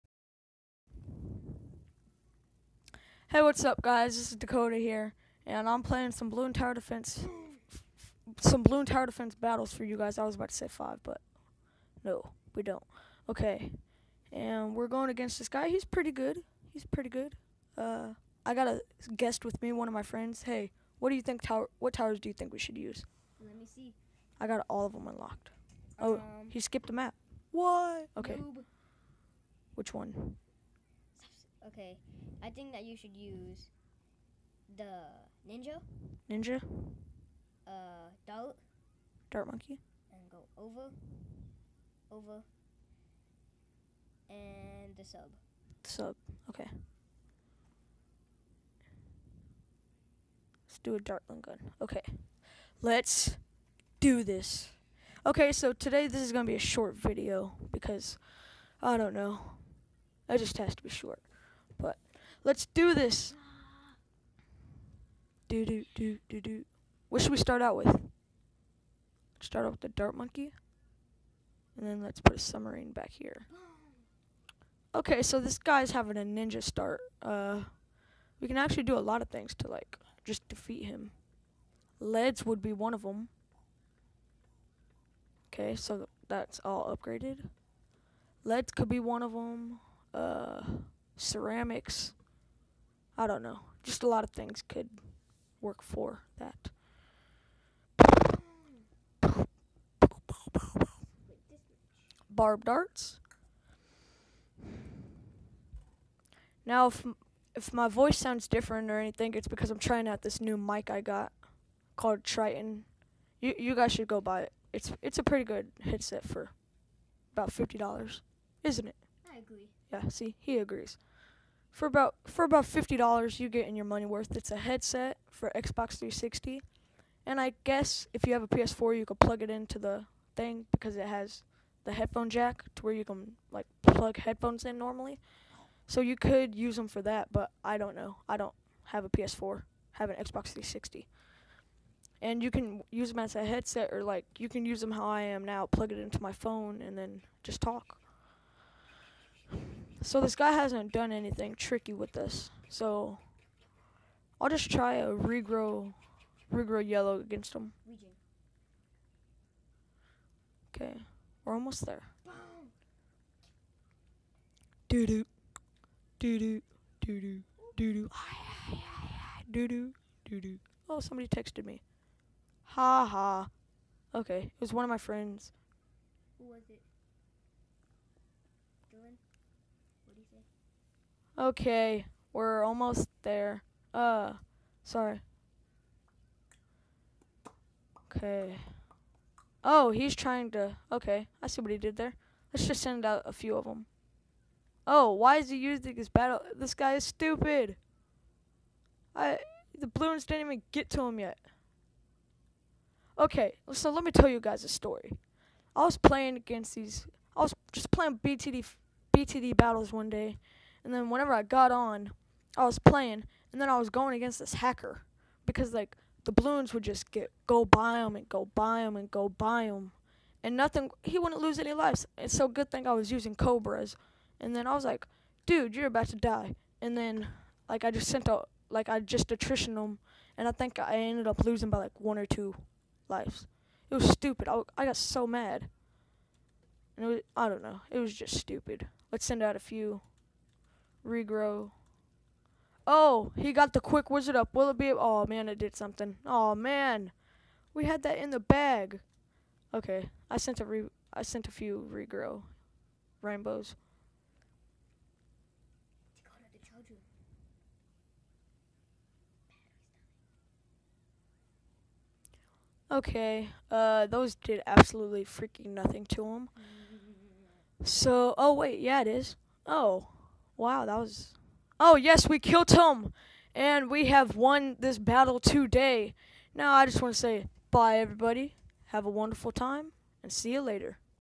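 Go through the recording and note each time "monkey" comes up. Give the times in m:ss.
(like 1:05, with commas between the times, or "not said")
0:39, 1:10.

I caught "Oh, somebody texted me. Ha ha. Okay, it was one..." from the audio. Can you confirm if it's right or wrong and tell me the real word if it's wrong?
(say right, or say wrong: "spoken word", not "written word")
right.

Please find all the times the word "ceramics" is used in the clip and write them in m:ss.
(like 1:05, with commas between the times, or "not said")
1:31.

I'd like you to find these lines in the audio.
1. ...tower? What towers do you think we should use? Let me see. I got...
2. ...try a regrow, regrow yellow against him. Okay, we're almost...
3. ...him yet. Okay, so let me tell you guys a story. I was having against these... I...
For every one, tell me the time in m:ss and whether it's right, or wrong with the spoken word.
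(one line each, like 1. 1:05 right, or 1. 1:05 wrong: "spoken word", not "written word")
1. 0:21 right
2. 2:34 right
3. 3:21 wrong: "playing", not "having".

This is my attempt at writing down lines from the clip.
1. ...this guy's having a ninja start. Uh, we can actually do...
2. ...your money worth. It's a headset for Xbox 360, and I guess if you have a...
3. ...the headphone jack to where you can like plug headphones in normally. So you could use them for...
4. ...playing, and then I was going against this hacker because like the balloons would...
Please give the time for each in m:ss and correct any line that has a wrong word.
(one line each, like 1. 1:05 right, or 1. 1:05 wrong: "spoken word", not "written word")
1. 1:15 right
2. 2:03 right
3. 2:11 right
4. 3:32 right.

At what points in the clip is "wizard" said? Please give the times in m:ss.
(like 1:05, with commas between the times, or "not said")
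4:04.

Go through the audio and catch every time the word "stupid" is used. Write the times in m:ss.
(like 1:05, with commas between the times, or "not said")
3:17, 3:54, 3:58.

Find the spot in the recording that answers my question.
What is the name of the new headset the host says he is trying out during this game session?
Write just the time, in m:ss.
1:52.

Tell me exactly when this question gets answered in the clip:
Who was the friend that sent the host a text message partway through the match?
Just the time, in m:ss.
2:58.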